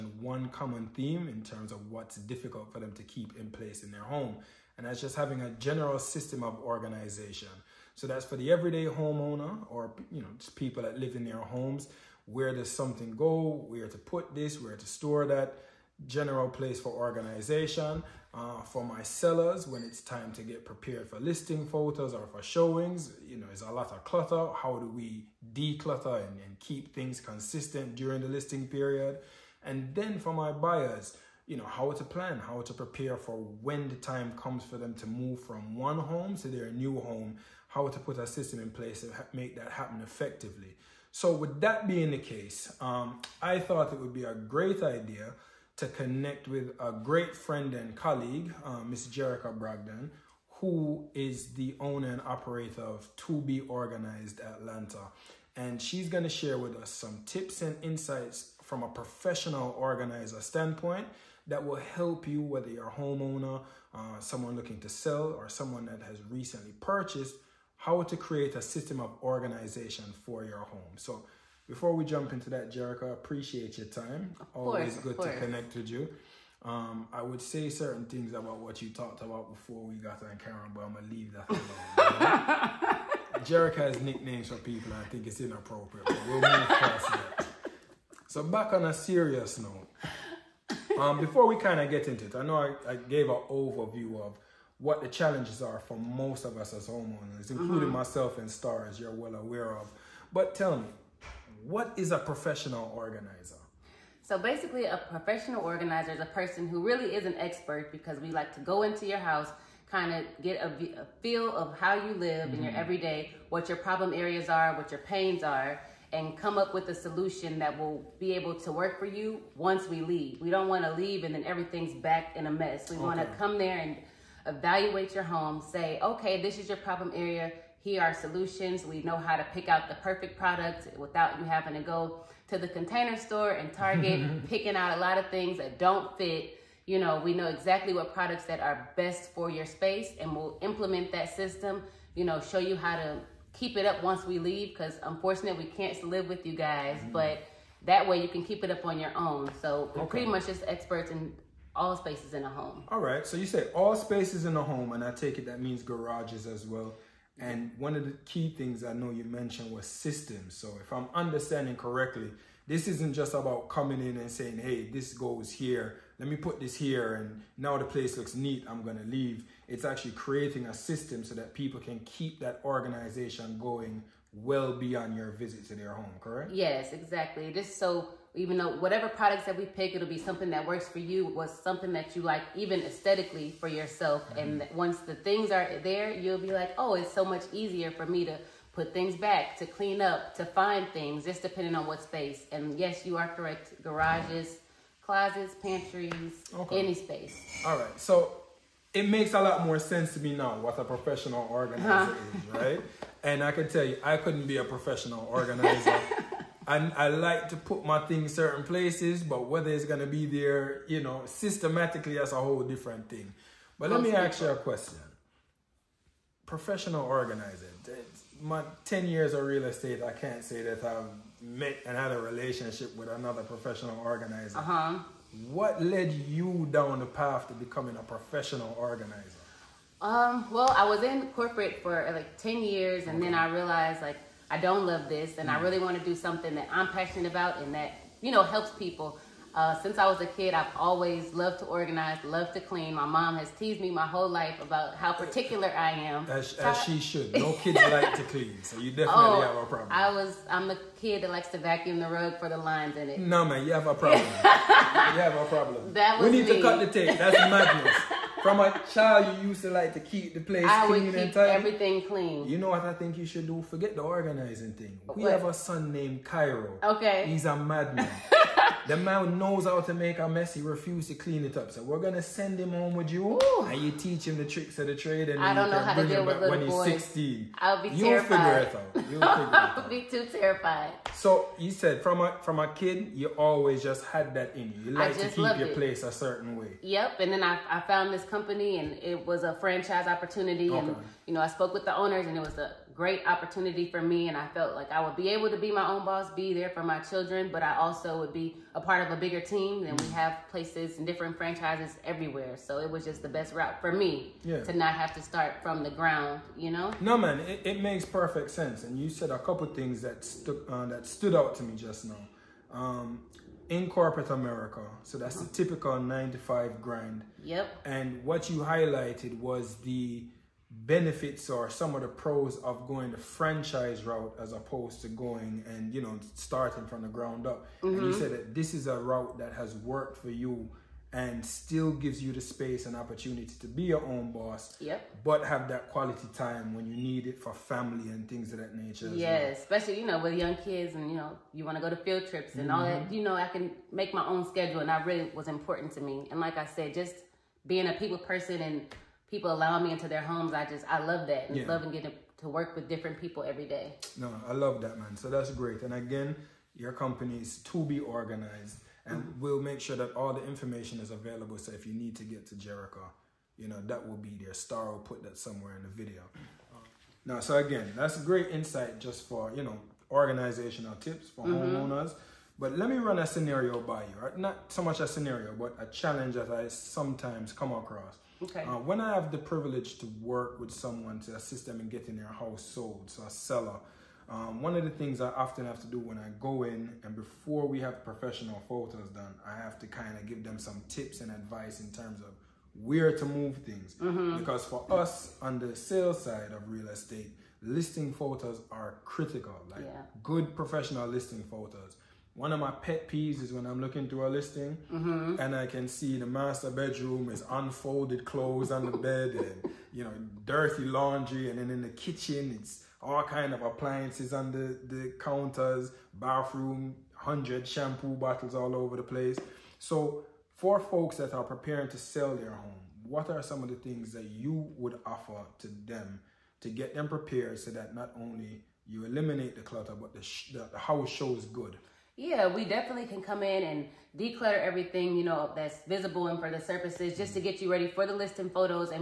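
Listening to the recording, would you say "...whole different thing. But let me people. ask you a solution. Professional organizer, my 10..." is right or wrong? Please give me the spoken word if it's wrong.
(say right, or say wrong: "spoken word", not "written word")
wrong: "question", not "solution".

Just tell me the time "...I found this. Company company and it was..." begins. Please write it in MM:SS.
04:47.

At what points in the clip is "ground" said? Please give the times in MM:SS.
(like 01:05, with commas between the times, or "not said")
05:05, 05:27.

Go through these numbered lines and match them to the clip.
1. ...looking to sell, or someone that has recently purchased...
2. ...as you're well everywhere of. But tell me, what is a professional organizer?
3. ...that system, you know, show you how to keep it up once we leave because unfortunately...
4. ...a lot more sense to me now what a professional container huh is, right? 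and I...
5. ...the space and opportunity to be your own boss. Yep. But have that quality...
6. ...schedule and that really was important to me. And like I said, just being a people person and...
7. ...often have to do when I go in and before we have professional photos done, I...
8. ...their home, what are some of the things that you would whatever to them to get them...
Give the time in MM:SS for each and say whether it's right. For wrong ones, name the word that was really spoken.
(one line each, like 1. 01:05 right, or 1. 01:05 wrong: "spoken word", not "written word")
1. 01:04 right
2. 01:38 wrong: "aware", not "everywhere"
3. 02:21 right
4. 03:19 wrong: "organizer", not "container"
5. 05:32 right
6. 05:44 right
7. 06:25 right
8. 07:02 wrong: "offer", not "whatever".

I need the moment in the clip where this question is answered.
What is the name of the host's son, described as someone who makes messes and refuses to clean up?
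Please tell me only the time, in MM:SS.
04:26.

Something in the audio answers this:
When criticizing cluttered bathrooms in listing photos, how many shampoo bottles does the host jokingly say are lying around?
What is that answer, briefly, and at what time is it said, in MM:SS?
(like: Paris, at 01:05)
100, at 06:57.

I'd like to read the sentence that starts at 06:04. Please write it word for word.
Star will put that somewhere in the video.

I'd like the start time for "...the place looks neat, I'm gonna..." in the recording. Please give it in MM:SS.
02:47.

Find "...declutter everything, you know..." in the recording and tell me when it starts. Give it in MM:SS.
07:14.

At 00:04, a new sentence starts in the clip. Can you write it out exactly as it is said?
And that's just having a general system of organization.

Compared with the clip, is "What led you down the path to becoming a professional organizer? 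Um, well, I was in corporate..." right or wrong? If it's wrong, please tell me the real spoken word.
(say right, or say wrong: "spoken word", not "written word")
right.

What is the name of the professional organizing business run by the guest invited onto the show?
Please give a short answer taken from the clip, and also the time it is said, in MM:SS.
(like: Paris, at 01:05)
To Be Organized Atlanta, at 00:53.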